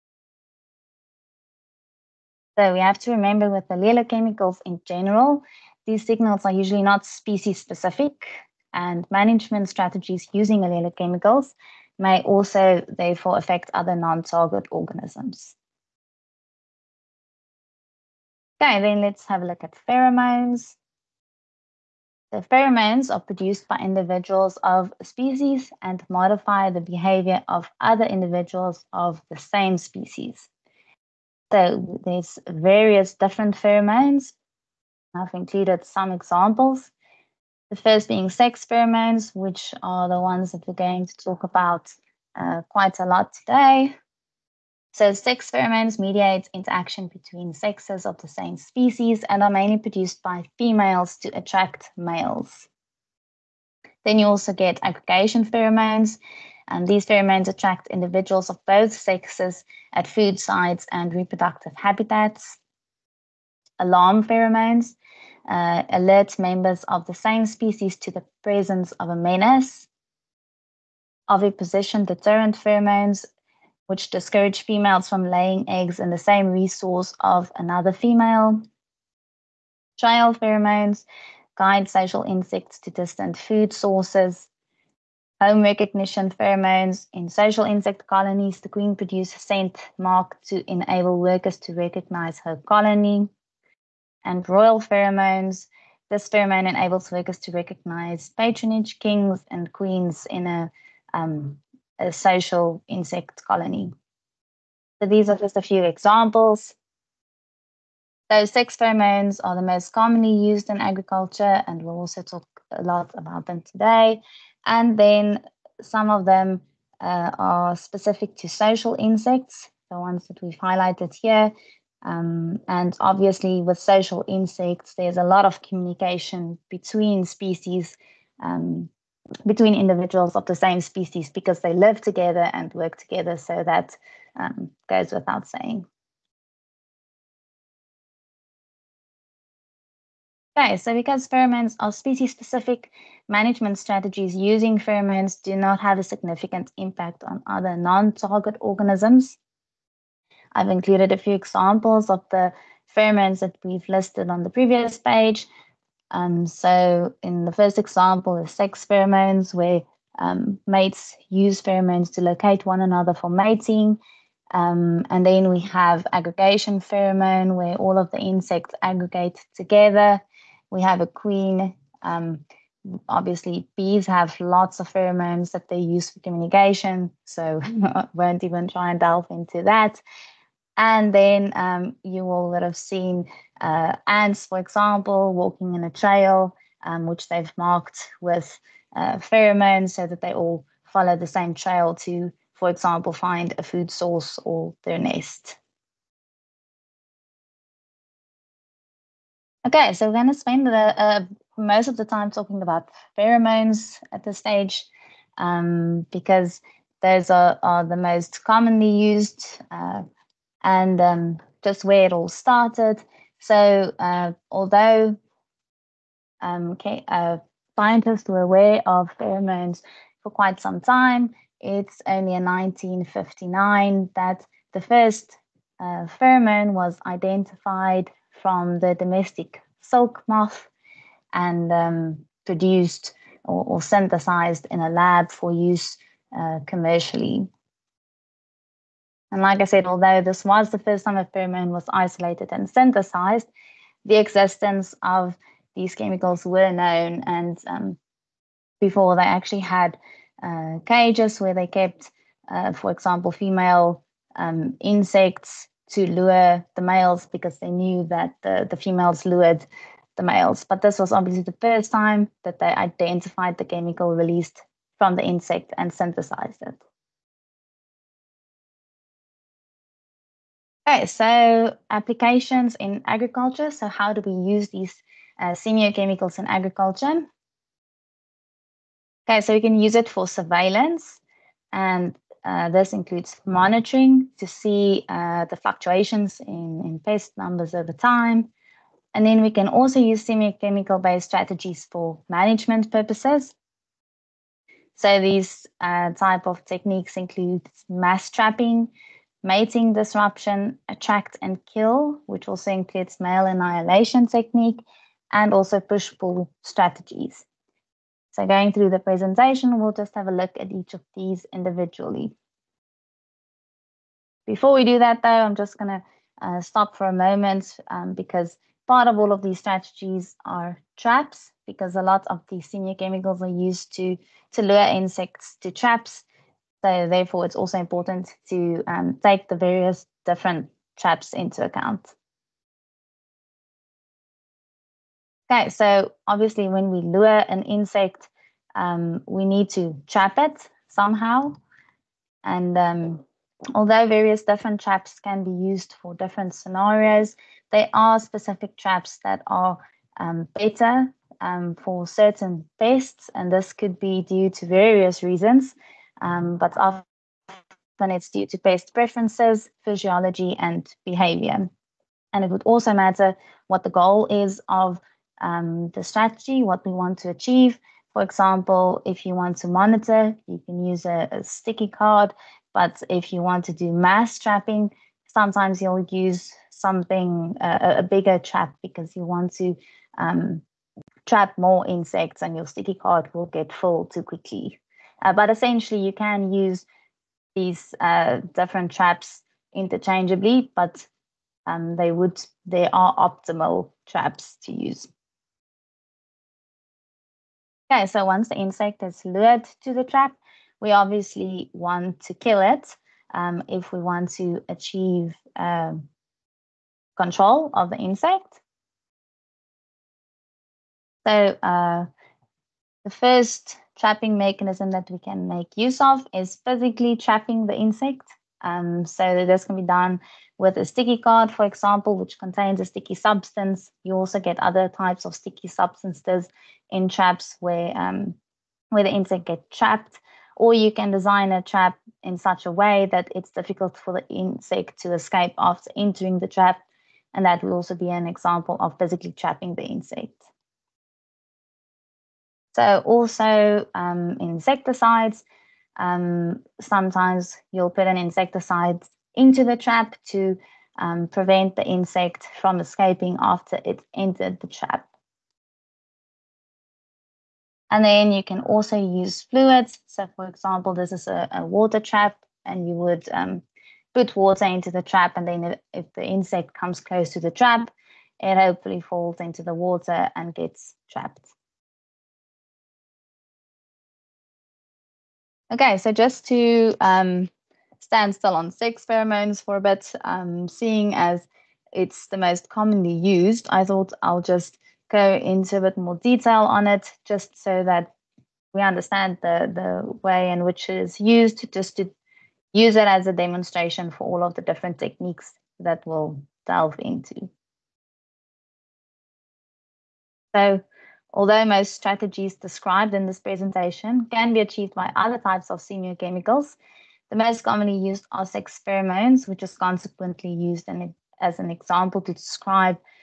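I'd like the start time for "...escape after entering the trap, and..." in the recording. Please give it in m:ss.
7:15.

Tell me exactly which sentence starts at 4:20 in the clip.
But this was obviously the first time that they identified the chemical released from the insect and synthesized it.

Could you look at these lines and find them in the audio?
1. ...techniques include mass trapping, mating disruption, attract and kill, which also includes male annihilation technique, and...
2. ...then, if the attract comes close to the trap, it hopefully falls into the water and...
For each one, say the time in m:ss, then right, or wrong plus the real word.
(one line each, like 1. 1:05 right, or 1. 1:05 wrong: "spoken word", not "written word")
1. 4:56 right
2. 7:45 wrong: "insect", not "attract".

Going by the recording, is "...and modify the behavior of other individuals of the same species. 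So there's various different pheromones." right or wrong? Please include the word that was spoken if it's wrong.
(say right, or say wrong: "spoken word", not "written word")
right.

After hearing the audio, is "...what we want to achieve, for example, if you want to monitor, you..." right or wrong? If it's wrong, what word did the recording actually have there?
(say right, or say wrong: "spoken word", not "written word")
right.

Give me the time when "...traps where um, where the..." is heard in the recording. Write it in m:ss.
7:07.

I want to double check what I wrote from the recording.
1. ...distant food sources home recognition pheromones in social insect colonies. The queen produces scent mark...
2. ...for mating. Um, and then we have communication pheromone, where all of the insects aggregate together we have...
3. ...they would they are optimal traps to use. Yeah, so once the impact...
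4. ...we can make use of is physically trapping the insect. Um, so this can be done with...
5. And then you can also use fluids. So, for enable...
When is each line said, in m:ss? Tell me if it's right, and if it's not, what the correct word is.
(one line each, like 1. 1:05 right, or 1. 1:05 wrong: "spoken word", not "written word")
1. 1:22 right
2. 2:43 wrong: "aggregation", not "communication"
3. 6:31 wrong: "insect", not "impact"
4. 6:55 right
5. 7:37 wrong: "example", not "enable".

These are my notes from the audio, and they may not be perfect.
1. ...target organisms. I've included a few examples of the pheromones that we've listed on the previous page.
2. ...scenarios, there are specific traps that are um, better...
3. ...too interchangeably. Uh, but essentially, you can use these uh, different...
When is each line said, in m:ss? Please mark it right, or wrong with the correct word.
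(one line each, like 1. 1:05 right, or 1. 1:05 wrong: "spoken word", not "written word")
1. 2:28 right
2. 5:46 right
3. 6:24 wrong: "quickly", not "interchangeably".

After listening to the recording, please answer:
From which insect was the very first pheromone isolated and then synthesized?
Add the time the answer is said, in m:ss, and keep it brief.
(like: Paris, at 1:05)
domestic silk moth, at 3:48.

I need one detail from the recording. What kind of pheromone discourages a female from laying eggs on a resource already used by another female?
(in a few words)
oviposition deterrent pheromones.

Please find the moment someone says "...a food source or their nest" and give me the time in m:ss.
3:13.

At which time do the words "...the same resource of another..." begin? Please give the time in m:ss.
1:16.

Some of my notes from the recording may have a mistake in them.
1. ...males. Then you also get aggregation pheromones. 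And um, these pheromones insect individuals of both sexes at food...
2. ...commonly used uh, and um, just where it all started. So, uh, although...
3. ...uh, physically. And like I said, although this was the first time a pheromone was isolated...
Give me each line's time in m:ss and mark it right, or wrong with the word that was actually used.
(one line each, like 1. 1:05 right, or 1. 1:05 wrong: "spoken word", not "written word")
1. 0:51 wrong: "attract", not "insect"
2. 3:28 right
3. 3:56 wrong: "commercially", not "physically".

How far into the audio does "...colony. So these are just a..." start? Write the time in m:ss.
1:43.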